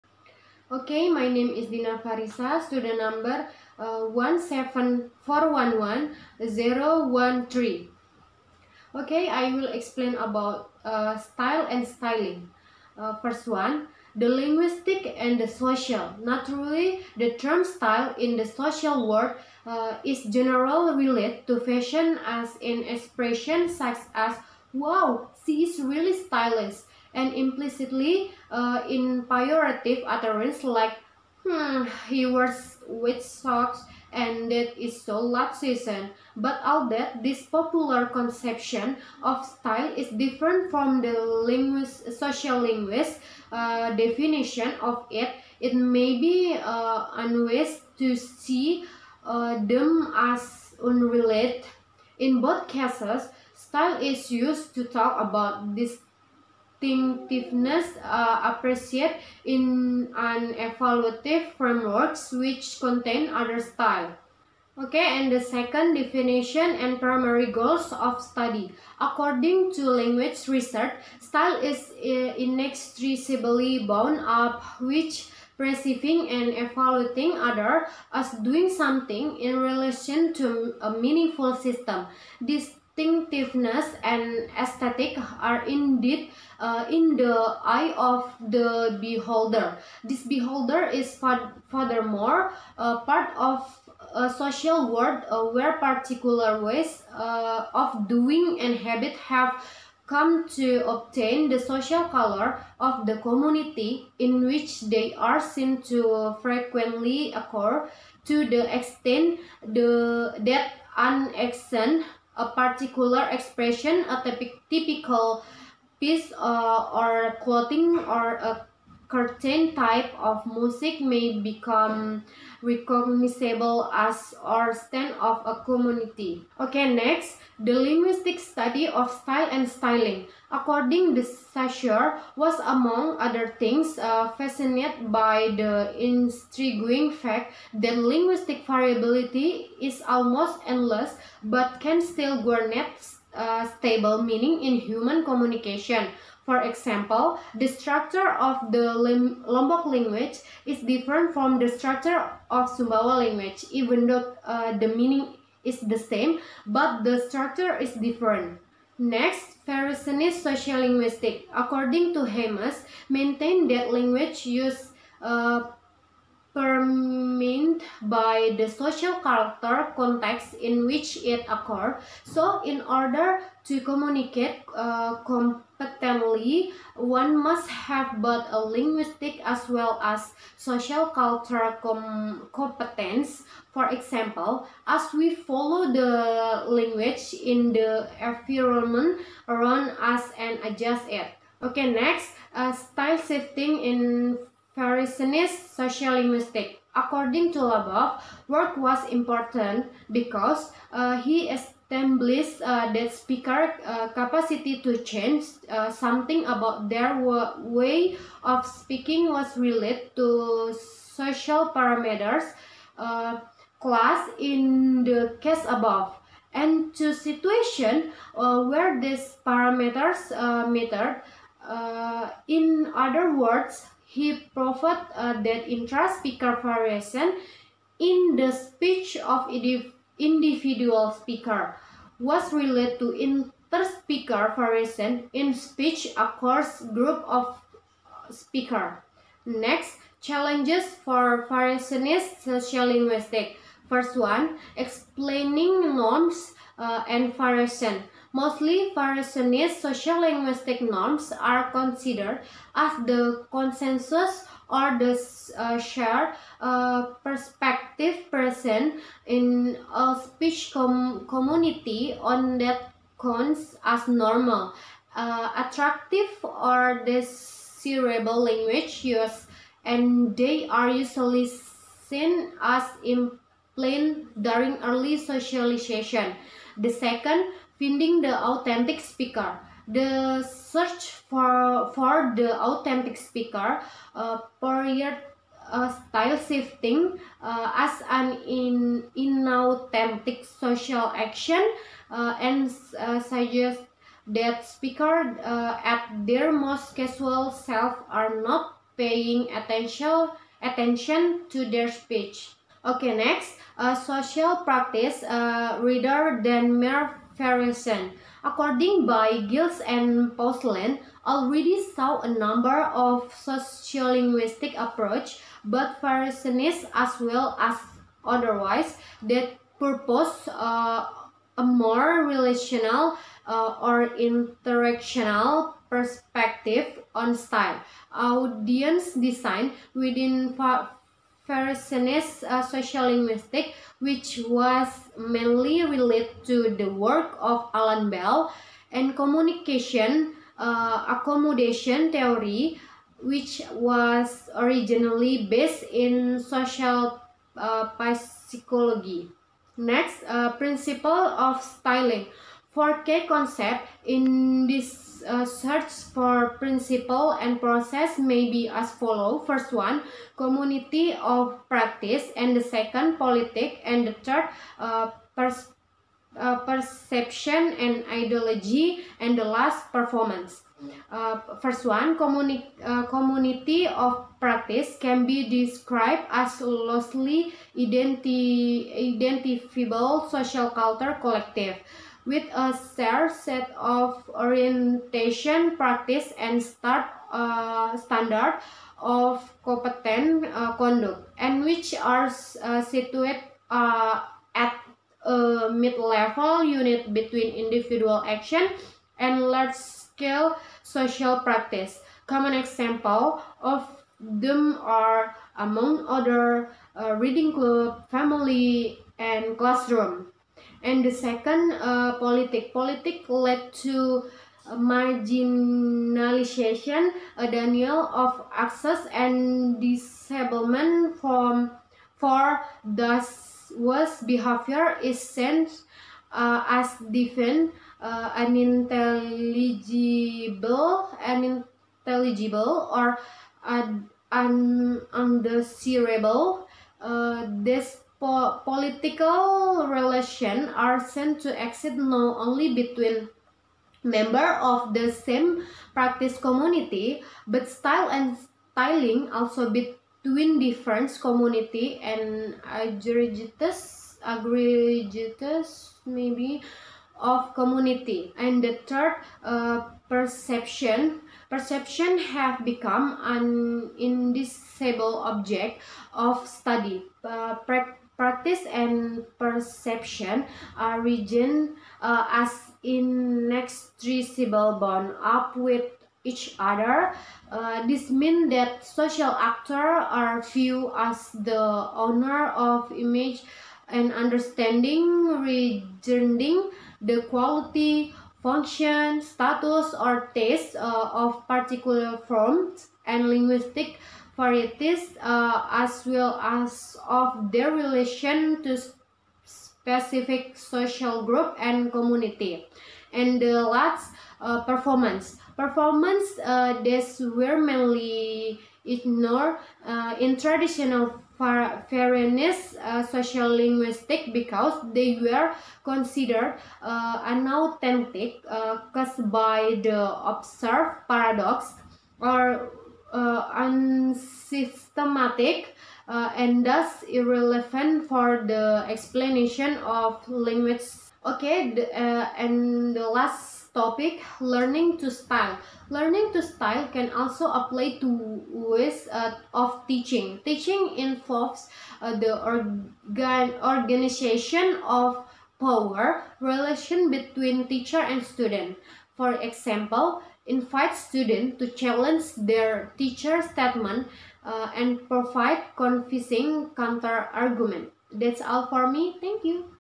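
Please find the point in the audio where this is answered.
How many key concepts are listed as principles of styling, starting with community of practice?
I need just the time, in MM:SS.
05:52.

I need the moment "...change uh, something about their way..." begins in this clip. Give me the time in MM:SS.
03:25.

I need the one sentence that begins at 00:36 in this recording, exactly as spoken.
But all that, this popular conception of style is different from the linguist, social linguist uh, definition of it.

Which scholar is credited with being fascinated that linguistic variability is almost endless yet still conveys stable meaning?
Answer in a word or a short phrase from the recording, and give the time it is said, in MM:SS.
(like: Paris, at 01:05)
Saussure, at 02:11.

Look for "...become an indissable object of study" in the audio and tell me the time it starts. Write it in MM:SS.
07:42.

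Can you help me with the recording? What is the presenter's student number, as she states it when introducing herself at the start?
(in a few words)
17411-013.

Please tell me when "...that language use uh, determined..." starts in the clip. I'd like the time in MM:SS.
02:43.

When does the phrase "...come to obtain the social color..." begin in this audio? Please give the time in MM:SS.
01:40.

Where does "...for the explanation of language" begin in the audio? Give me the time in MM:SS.
08:48.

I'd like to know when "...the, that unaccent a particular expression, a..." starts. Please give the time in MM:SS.
01:49.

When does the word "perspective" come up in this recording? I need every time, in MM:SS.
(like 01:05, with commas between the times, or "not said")
04:17, 05:25.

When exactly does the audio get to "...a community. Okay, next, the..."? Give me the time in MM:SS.
02:05.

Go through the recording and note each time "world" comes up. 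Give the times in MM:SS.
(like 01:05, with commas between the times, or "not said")
00:19, 01:34.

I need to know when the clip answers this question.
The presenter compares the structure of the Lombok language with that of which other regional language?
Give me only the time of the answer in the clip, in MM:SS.
02:32.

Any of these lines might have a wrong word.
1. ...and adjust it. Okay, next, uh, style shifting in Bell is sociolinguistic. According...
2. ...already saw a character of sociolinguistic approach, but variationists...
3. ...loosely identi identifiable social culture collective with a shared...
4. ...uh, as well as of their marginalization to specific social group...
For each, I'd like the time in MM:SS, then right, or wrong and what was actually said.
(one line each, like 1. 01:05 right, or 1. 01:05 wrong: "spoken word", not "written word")
1. 03:10 wrong: "Parisian", not "Bell"
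2. 05:11 wrong: "number", not "character"
3. 06:16 right
4. 08:15 wrong: "relation", not "marginalization".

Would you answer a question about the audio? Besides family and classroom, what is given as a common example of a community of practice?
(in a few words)
reading club.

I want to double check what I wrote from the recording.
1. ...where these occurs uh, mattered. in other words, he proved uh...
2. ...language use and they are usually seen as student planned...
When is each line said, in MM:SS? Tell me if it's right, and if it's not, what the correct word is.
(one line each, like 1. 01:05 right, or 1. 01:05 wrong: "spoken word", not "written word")
1. 03:38 wrong: "parameters", not "occurs"
2. 04:28 wrong: "important", not "student".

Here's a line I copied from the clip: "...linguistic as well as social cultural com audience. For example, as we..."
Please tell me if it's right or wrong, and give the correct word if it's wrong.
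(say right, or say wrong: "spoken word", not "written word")
wrong: "competence", not "audience".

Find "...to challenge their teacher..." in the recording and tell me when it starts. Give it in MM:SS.
09:11.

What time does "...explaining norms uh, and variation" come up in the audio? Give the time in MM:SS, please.
04:04.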